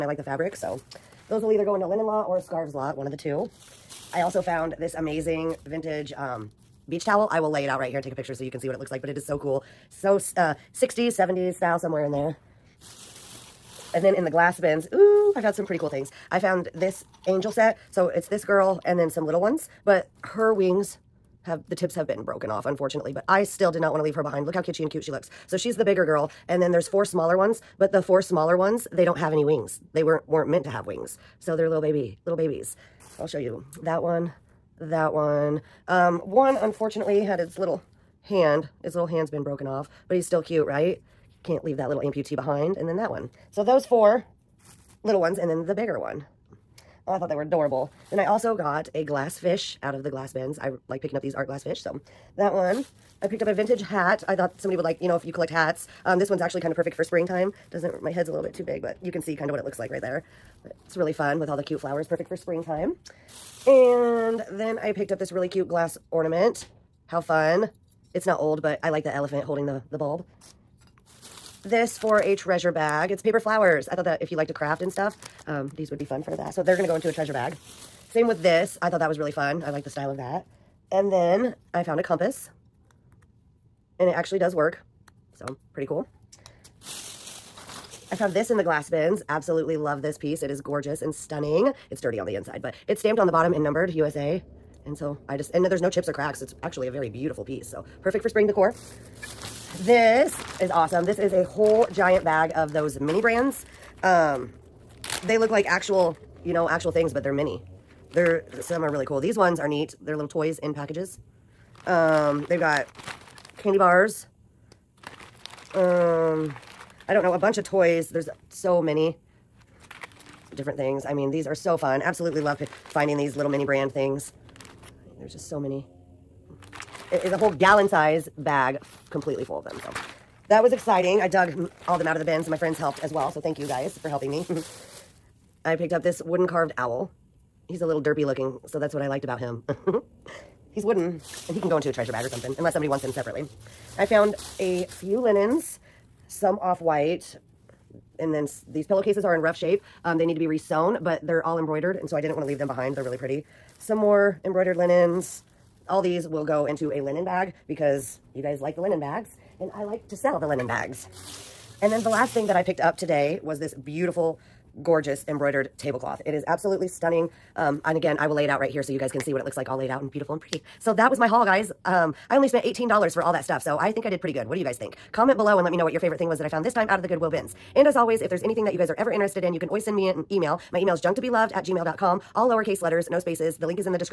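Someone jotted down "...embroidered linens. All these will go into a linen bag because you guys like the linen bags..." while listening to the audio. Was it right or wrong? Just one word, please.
right.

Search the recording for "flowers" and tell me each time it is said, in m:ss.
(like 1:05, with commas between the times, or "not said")
1:01, 1:13.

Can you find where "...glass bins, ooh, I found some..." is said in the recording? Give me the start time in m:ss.
0:14.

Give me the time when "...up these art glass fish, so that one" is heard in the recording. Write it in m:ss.
0:51.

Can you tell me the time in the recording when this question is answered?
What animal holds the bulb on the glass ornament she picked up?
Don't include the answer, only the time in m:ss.
1:09.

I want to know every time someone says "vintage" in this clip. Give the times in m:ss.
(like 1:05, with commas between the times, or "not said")
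0:05, 0:53.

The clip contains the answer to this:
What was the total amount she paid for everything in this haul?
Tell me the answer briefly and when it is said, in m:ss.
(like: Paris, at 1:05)
$18, at 2:52.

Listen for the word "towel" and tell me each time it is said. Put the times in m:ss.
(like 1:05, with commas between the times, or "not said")
0:07.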